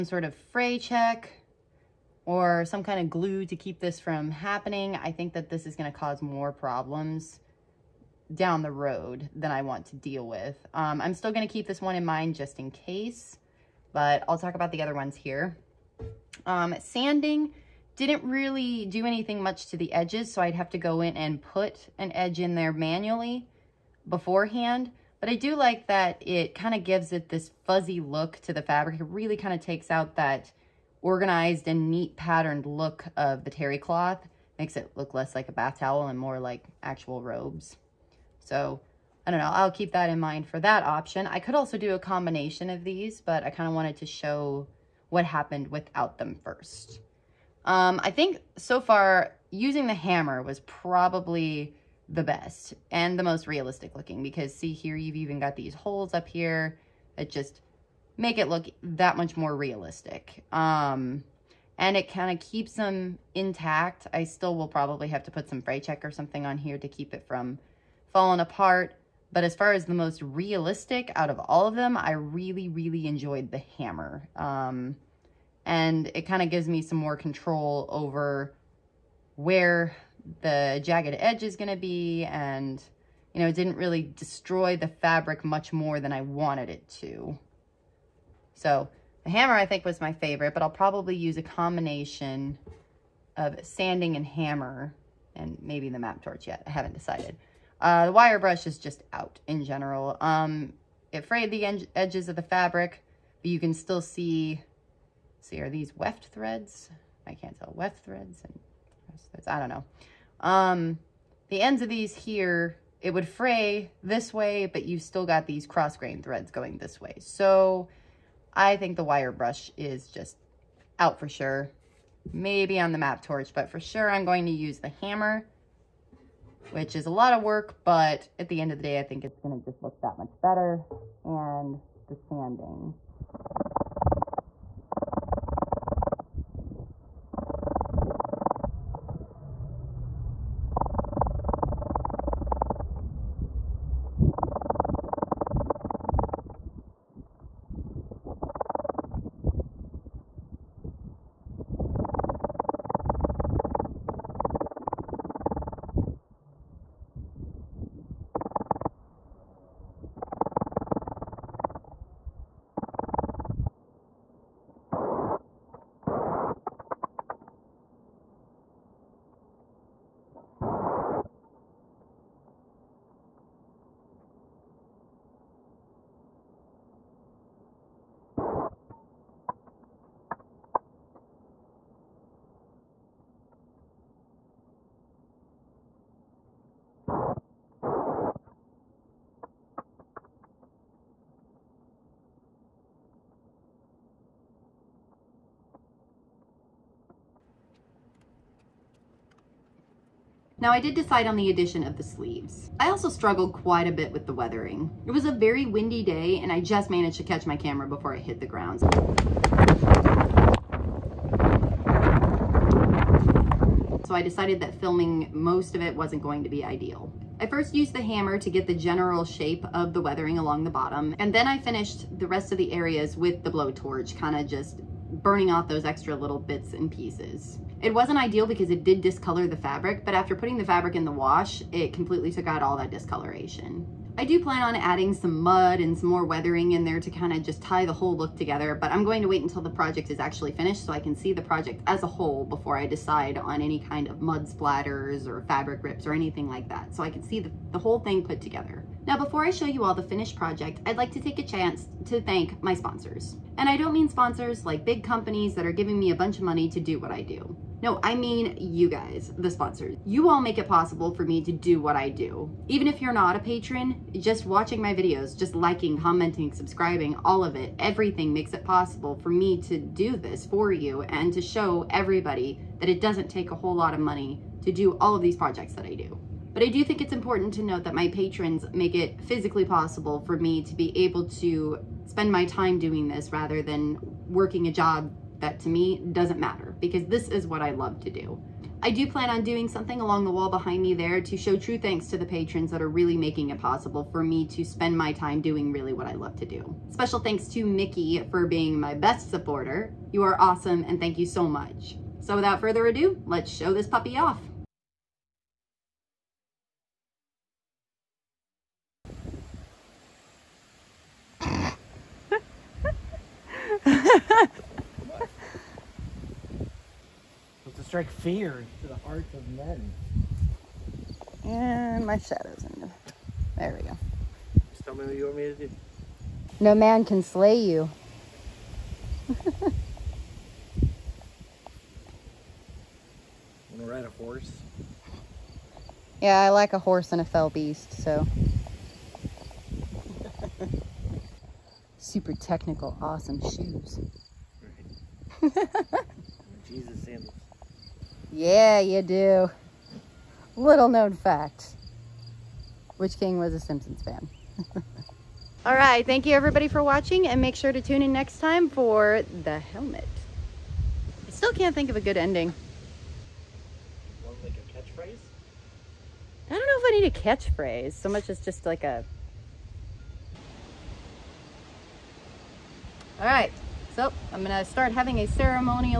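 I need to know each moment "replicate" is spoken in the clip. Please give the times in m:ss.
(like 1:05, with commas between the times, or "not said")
not said.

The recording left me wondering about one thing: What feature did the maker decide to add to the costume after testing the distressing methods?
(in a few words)
Sleeves.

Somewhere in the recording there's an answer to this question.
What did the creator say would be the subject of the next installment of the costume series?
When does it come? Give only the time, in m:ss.
5:59.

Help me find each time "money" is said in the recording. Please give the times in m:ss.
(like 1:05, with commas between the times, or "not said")
4:16, 4:33.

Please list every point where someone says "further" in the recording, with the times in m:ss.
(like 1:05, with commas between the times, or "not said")
5:02.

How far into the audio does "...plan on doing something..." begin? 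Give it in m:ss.
4:49.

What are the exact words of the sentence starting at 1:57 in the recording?
So I think the wire brush is just out for sure.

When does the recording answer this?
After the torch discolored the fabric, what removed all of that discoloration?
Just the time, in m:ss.
3:51.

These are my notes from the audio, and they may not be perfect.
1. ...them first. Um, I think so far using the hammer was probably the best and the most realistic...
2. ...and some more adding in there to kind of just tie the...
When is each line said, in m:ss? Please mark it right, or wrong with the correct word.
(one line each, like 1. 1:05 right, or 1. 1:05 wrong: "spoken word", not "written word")
1. 0:46 right
2. 3:55 wrong: "weathering", not "adding".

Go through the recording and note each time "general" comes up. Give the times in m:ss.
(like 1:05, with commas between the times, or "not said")
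1:39, 3:38.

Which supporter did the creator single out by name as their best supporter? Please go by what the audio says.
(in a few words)
Mickey.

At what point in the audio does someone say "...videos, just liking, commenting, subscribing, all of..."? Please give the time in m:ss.
4:24.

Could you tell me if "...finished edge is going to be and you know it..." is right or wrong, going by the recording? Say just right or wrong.
wrong.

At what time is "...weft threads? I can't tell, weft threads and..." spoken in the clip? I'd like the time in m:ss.
1:45.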